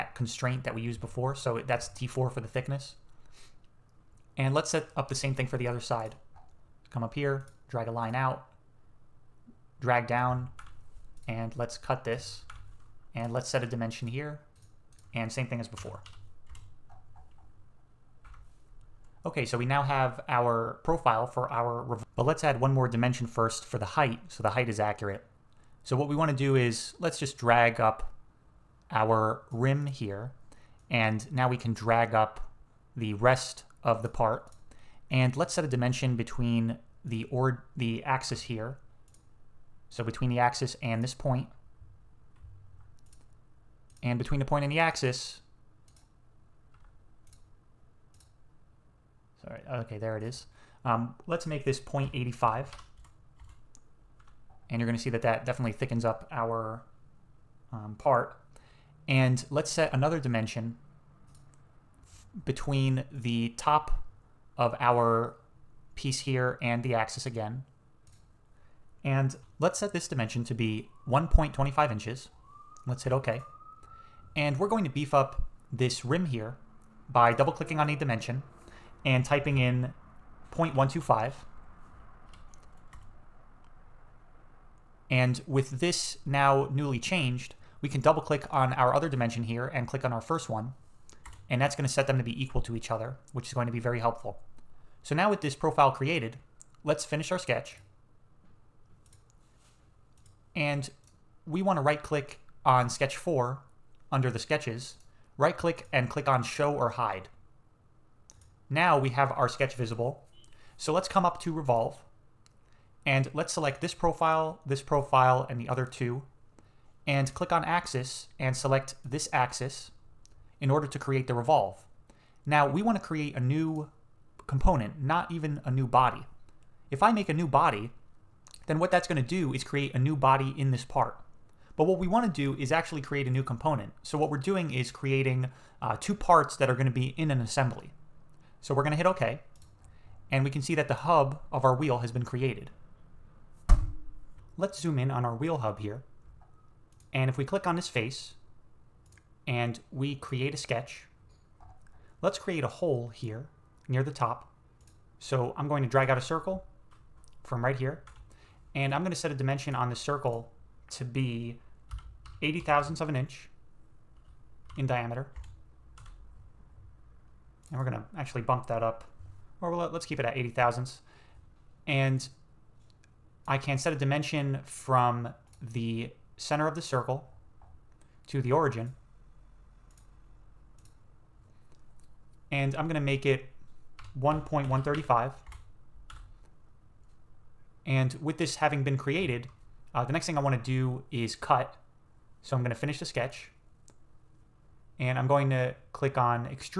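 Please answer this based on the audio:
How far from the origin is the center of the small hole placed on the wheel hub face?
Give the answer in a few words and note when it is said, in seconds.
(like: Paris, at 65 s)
1.135, at 184 s.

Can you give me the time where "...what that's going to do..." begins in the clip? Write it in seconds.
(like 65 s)
128 s.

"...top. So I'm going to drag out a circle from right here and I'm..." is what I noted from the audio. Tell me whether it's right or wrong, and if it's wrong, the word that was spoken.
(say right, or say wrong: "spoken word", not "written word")
right.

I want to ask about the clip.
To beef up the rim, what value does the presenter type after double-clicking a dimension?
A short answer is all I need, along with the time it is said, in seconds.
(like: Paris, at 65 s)
0.125, at 80 s.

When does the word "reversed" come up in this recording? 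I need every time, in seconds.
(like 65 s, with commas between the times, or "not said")
not said.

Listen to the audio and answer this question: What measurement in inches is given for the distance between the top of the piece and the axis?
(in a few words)
1.25 inches.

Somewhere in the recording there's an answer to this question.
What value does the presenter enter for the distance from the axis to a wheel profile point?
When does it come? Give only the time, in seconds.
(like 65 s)
51 s.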